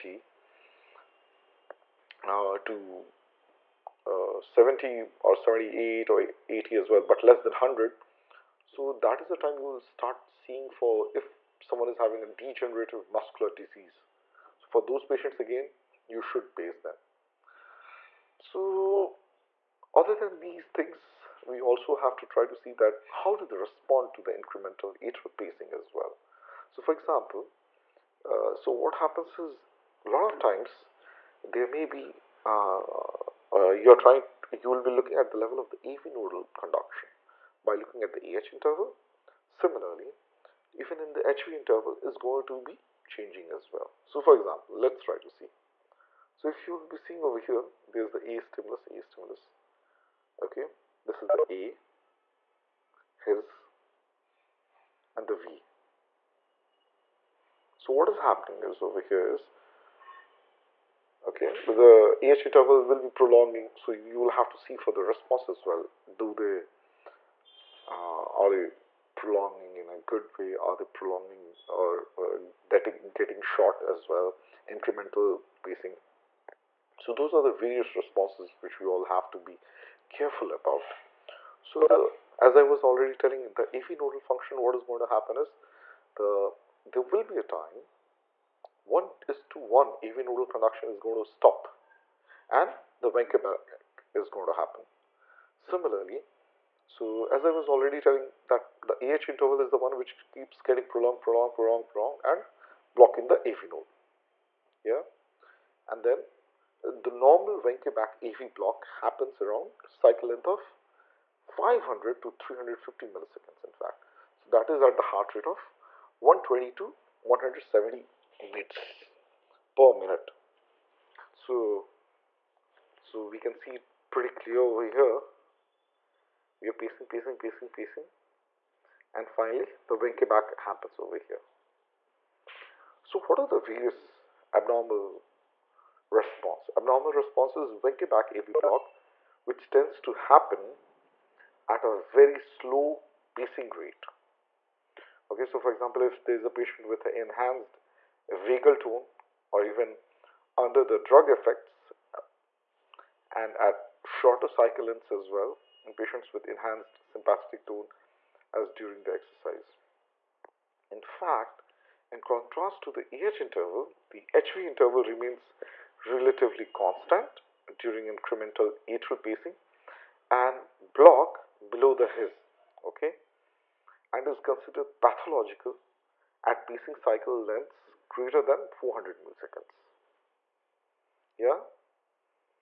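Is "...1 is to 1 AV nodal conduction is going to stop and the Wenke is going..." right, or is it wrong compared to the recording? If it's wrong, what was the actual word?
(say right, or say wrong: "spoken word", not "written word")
right.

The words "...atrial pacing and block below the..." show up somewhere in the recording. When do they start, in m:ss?
2:48.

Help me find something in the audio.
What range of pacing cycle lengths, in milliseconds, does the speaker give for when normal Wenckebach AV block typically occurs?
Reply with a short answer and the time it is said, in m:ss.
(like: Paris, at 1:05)
500 to 350 milliseconds, at 1:51.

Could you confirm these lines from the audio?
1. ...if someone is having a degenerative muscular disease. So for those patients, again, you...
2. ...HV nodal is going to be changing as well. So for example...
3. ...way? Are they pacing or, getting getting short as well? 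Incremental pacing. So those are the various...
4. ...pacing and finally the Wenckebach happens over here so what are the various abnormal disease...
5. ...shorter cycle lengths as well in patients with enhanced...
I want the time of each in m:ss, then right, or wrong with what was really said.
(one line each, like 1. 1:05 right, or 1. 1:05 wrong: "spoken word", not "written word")
1. 0:11 right
2. 0:41 wrong: "interval", not "nodal"
3. 1:10 wrong: "prolonging", not "pacing"
4. 2:07 wrong: "response", not "disease"
5. 2:34 right.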